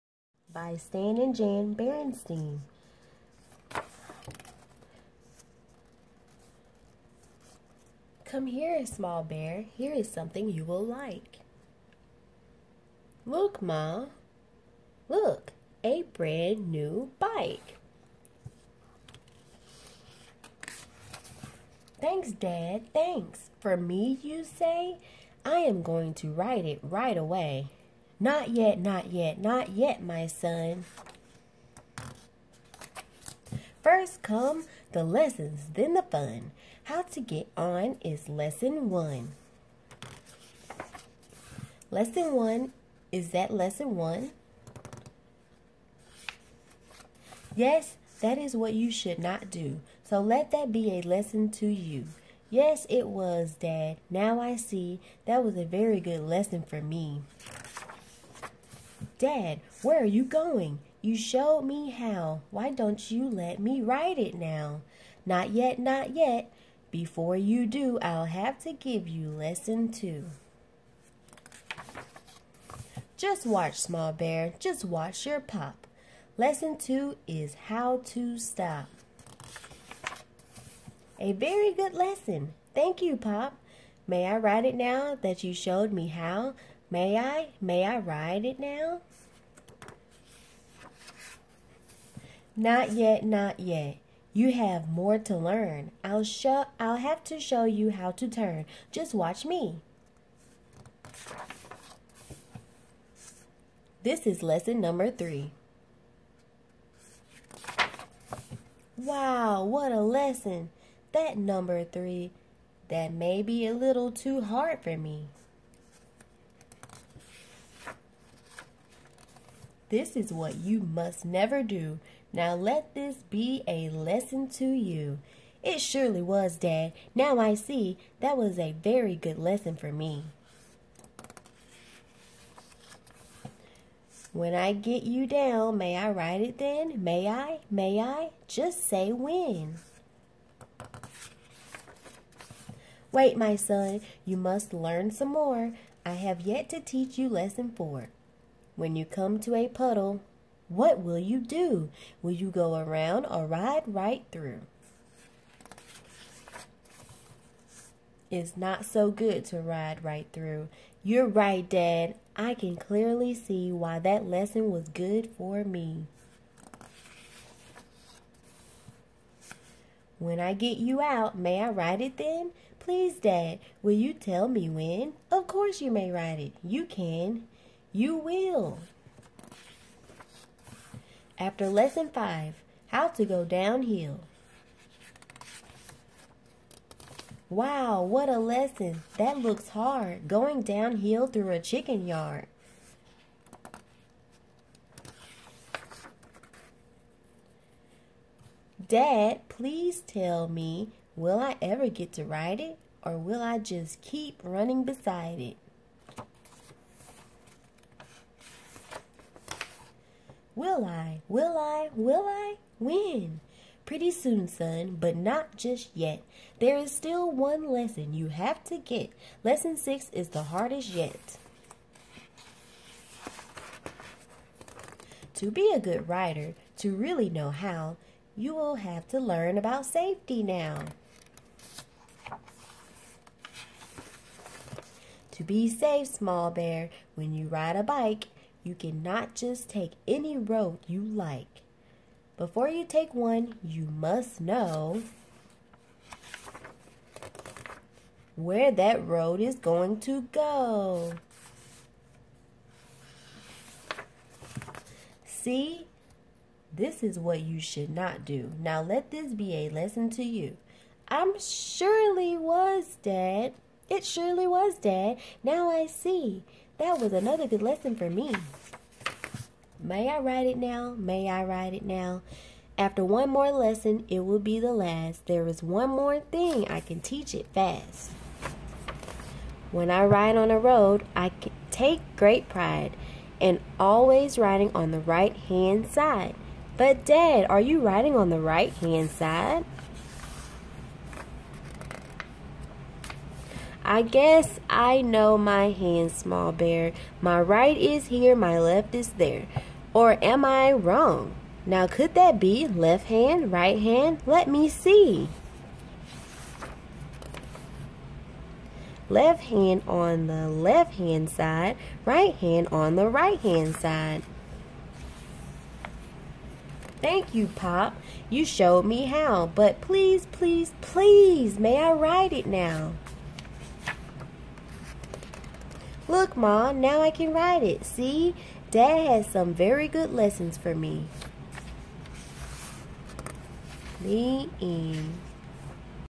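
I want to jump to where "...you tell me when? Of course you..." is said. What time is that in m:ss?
2:53.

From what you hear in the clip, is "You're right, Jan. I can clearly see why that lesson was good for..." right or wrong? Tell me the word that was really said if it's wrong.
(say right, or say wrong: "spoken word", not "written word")
wrong: "Dad", not "Jan".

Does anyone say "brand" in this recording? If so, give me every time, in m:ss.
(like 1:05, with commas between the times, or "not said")
0:16.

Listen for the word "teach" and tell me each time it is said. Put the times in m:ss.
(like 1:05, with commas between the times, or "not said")
2:26, 4:37.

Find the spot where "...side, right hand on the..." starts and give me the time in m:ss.
5:11.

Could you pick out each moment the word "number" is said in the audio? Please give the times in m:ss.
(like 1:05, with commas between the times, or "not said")
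1:44, 1:51.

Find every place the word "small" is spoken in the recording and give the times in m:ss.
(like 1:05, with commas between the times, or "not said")
0:08, 1:13, 3:56, 4:56.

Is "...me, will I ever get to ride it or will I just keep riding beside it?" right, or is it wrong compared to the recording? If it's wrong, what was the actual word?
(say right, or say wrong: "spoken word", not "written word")
wrong: "running", not "riding".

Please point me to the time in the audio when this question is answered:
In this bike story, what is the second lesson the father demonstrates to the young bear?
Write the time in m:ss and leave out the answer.
1:17.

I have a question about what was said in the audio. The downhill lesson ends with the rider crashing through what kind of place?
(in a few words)
A chicken yard.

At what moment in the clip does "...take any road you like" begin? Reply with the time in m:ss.
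3:59.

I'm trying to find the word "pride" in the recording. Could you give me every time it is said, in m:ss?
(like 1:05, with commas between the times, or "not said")
4:42.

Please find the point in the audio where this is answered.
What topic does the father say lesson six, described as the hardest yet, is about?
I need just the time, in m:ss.
3:49.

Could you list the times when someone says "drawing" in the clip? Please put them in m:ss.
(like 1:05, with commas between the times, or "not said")
not said.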